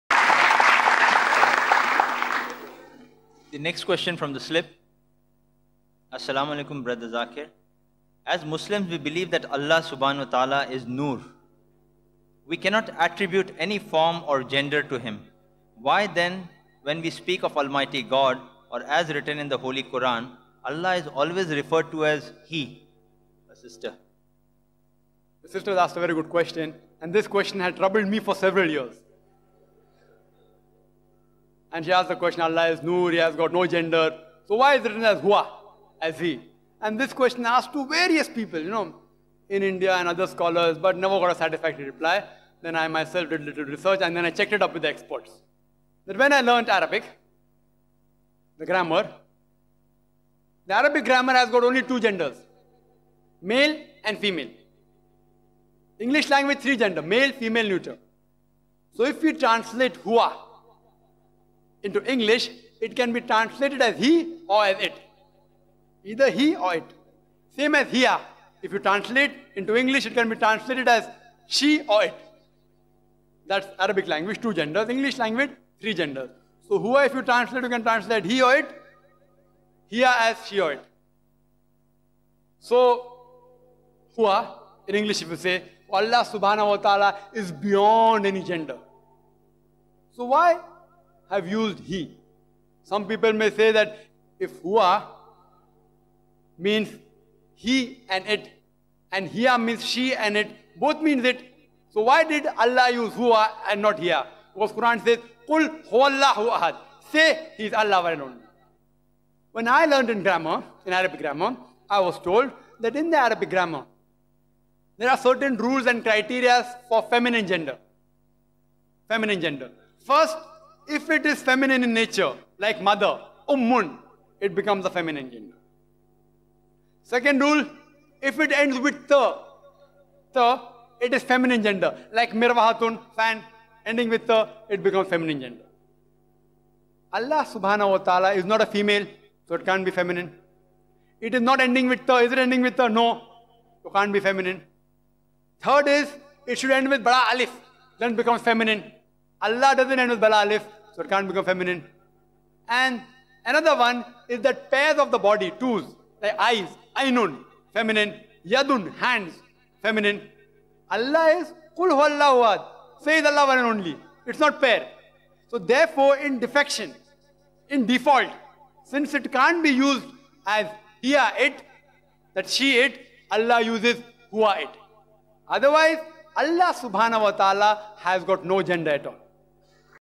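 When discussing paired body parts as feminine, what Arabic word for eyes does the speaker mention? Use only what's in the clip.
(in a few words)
Ainun.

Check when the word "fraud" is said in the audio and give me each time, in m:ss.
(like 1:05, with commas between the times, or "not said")
not said.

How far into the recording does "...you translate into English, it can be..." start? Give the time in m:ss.
1:08.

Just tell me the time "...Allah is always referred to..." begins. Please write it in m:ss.
0:20.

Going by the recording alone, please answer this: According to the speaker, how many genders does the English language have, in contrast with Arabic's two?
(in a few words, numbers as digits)
3.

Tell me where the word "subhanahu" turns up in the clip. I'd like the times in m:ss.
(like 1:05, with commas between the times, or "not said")
0:09, 1:26, 2:17, 2:56.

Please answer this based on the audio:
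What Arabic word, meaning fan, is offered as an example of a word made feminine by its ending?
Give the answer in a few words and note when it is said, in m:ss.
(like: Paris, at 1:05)
mirwahatun, at 2:12.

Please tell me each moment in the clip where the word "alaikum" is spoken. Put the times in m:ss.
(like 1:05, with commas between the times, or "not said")
0:06.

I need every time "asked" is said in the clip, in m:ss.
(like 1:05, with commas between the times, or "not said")
0:25, 0:31, 0:37.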